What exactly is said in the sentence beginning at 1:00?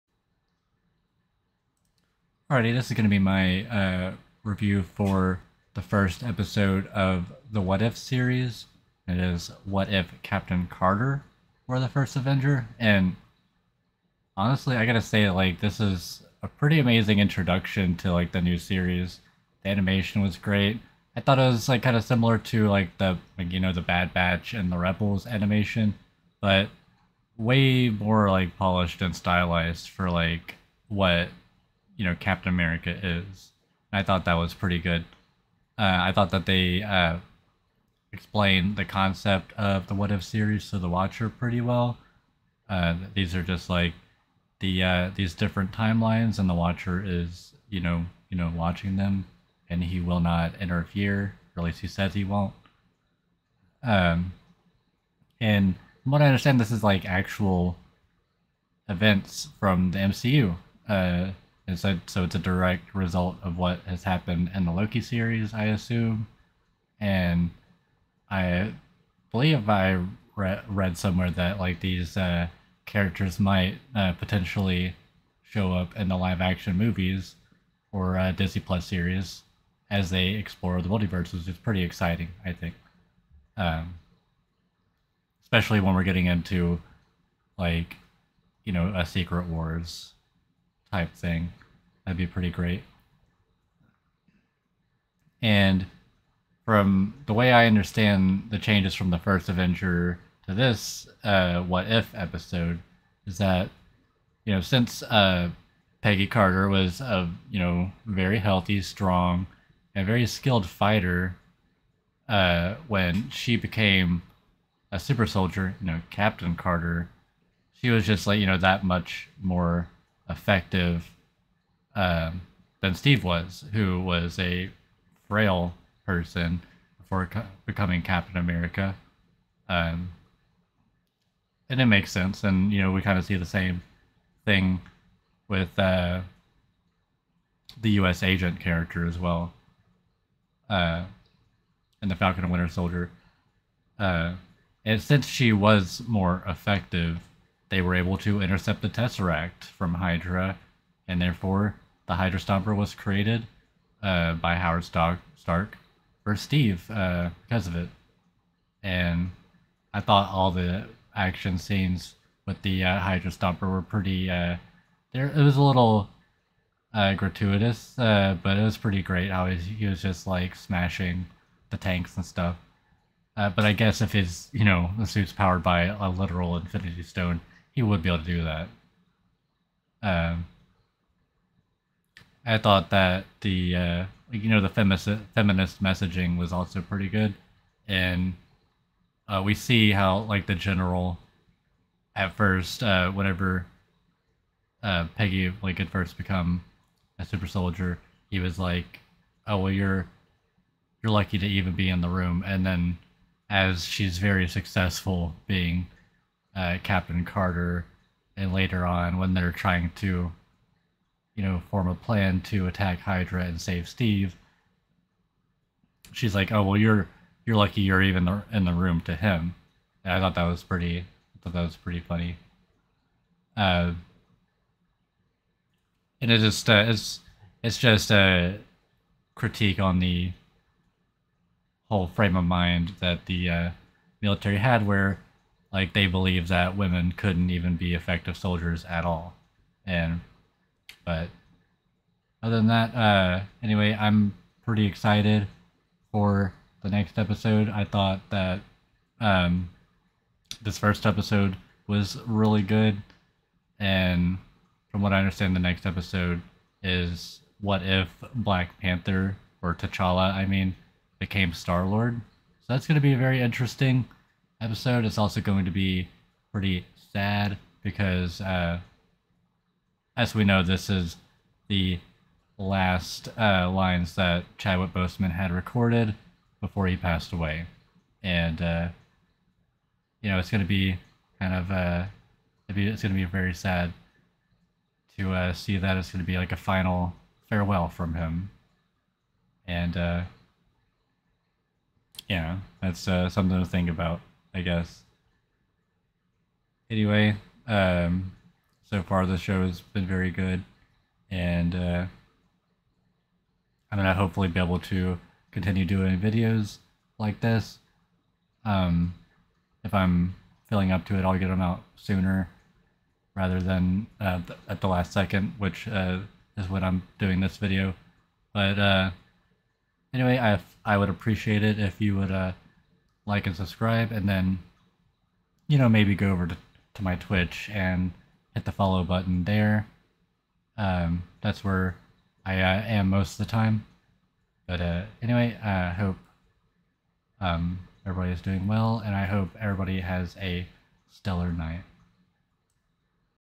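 Uh, so, so it's a direct result of what has happened in the Loki series, I assume.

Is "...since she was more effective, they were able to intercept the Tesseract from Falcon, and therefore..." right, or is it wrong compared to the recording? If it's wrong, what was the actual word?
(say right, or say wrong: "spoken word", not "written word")
wrong: "Hydra", not "Falcon".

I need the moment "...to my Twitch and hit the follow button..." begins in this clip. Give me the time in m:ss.
5:26.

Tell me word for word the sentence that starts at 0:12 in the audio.
And honestly, I gotta say, like, this is a pretty amazing introduction to, like, the new series.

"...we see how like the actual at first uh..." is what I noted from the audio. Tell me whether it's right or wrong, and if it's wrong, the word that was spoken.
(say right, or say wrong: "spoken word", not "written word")
wrong: "general", not "actual".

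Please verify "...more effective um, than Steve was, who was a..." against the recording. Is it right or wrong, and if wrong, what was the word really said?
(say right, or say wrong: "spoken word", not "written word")
right.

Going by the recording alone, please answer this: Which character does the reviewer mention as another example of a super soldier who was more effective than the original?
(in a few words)
U.S. Agent.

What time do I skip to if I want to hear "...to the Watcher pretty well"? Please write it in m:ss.
0:40.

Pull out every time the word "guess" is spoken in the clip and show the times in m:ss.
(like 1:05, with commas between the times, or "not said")
2:53, 4:54.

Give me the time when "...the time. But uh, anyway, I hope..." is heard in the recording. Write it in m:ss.
5:33.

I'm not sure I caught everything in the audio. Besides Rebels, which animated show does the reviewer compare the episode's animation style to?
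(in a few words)
The Bad Batch.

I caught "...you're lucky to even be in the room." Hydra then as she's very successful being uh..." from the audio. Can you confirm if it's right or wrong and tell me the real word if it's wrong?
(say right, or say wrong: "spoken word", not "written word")
wrong: "And", not "Hydra".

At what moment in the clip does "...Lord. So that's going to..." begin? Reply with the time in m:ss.
4:21.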